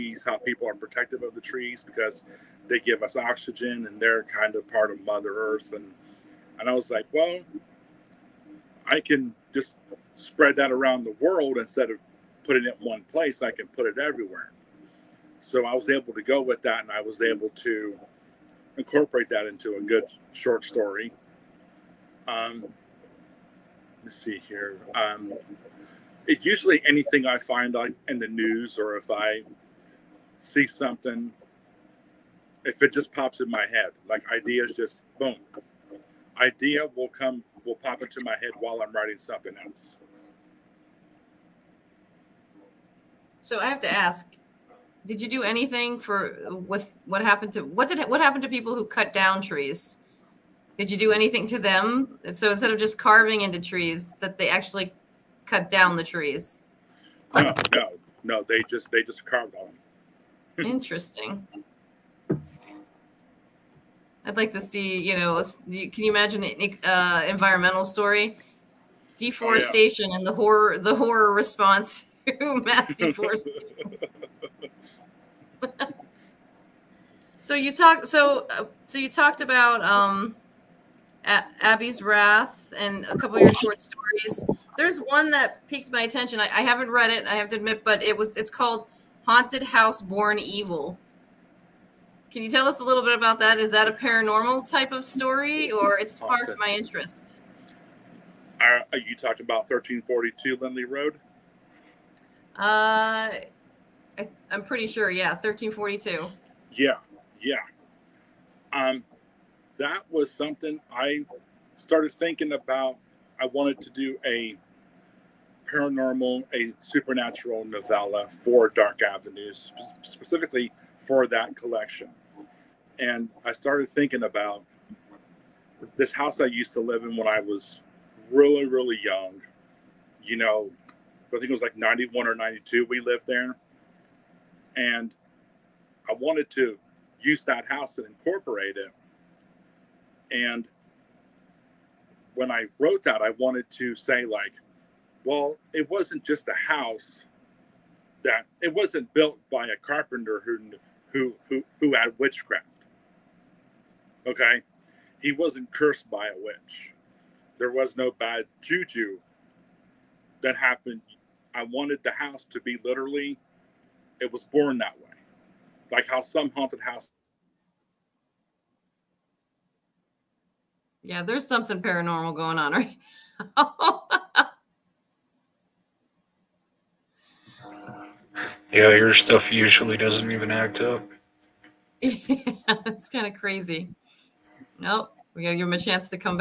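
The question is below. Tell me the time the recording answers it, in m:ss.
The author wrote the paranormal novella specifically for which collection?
1:58.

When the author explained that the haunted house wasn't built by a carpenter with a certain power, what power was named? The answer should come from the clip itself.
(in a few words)
Witchcraft.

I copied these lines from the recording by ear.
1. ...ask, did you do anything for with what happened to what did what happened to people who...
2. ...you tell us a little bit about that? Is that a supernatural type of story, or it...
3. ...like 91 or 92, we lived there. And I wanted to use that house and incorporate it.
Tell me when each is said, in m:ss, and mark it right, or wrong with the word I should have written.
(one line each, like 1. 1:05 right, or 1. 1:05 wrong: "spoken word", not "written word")
1. 0:43 right
2. 1:32 wrong: "paranormal", not "supernatural"
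3. 2:11 right.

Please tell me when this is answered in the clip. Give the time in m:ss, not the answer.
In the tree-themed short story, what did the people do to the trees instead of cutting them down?
0:59.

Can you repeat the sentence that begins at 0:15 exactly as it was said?
So I was able to go with that, and I was able to incorporate that into a good short story.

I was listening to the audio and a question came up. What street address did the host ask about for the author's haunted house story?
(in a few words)
1342 Lindley Road.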